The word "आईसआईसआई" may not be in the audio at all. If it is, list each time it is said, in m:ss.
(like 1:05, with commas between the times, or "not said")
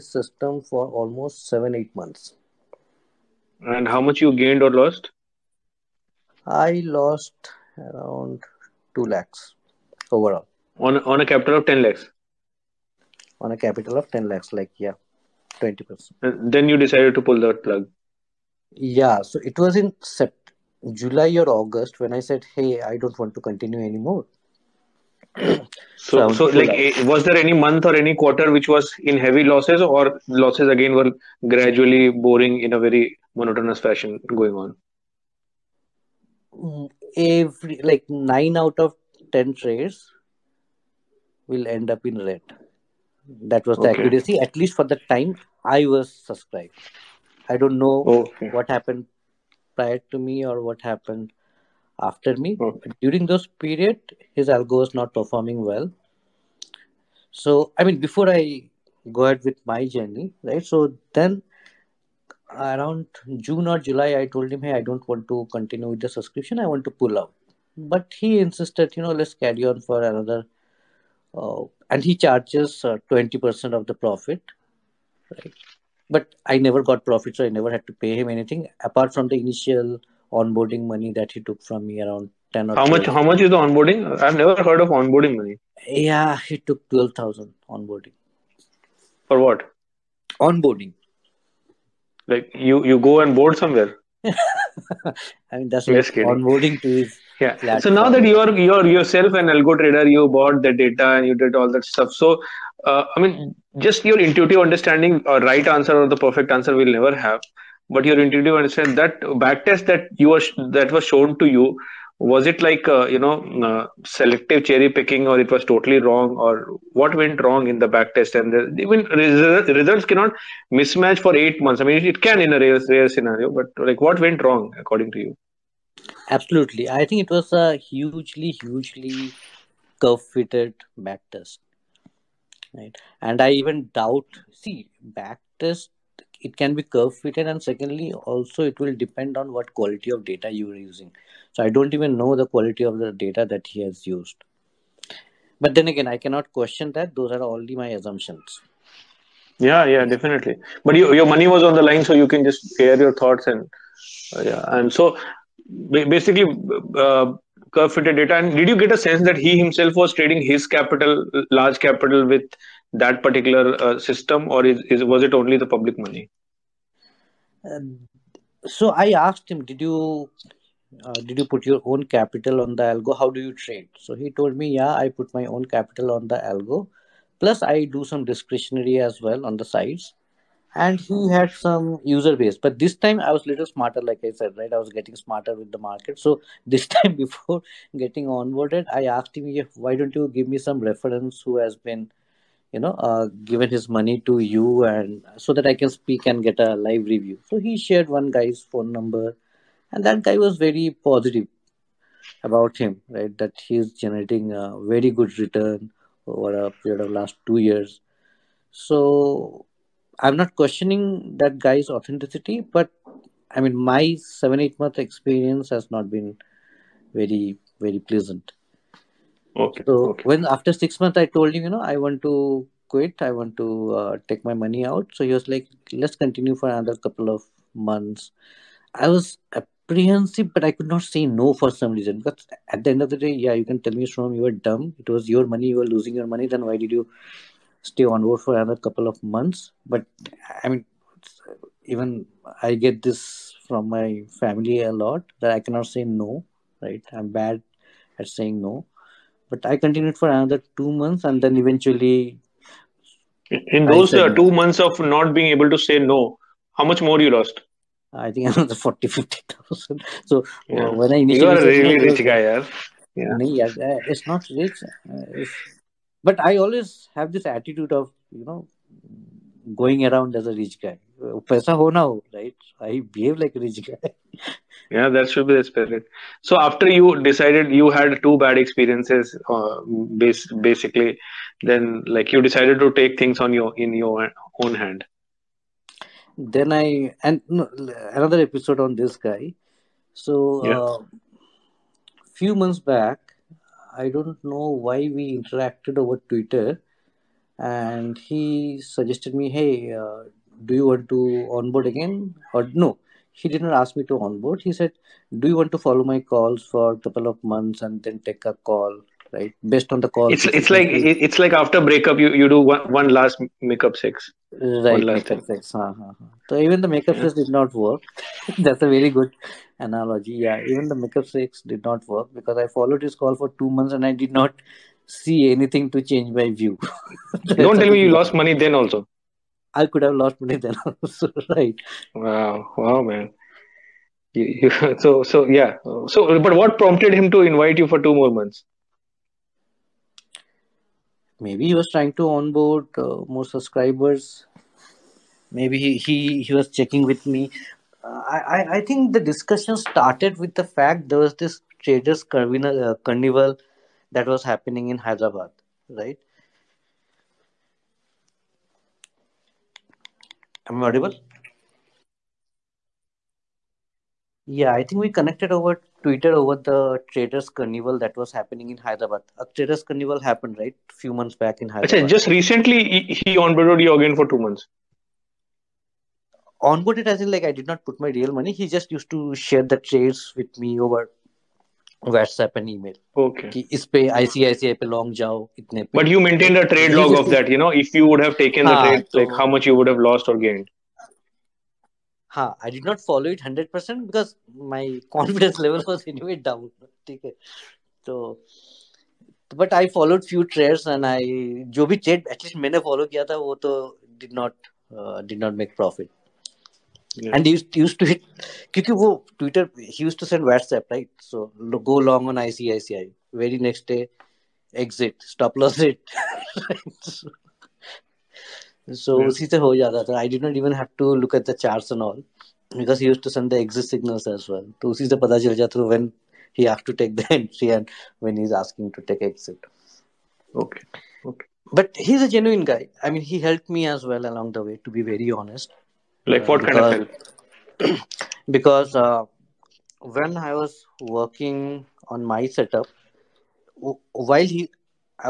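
6:24.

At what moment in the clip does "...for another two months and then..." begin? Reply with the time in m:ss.
4:10.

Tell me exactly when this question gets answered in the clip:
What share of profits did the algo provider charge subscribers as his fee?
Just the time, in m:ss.
1:13.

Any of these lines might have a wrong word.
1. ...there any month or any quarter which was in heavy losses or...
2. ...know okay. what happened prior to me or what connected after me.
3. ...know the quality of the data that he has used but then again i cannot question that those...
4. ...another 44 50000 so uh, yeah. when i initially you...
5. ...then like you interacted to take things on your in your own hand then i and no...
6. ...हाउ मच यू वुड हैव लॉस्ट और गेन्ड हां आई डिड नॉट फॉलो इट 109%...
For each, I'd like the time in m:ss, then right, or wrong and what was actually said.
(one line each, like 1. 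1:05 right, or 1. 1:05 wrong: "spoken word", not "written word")
1. 0:27 right
2. 0:47 wrong: "happened", not "connected"
3. 2:22 right
4. 4:18 wrong: "40", not "44"
5. 4:41 wrong: "decided", not "interacted"
6. 6:29 wrong: "100", not "109".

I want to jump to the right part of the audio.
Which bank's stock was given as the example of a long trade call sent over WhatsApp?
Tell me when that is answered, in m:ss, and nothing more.
6:52.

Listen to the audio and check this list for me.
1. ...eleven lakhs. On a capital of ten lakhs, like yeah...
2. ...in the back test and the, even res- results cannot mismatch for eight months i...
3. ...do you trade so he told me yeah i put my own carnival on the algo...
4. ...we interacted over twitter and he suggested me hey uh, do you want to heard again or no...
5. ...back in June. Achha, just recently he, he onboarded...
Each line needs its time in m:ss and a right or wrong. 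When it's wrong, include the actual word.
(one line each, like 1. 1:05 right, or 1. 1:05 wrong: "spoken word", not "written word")
1. 0:11 wrong: "ten", not "eleven"
2. 1:57 right
3. 2:53 wrong: "capital", not "carnival"
4. 4:55 wrong: "onboard", not "heard"
5. 6:11 wrong: "Hyderabad", not "June".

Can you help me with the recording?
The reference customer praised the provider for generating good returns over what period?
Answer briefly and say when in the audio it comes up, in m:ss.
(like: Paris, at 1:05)
2 years, at 3:27.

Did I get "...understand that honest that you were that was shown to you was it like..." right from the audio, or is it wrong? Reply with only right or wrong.
wrong.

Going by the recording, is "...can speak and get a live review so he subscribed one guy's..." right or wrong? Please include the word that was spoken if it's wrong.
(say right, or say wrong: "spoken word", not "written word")
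wrong: "shared", not "subscribed".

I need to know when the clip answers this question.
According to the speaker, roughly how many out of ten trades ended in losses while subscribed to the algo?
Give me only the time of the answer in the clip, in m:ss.
0:38.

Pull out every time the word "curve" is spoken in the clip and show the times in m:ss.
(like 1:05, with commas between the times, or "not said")
2:10, 2:16, 2:37.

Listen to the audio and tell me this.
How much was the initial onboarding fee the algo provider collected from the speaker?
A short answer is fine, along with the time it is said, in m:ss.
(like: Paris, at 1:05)
12000, at 1:26.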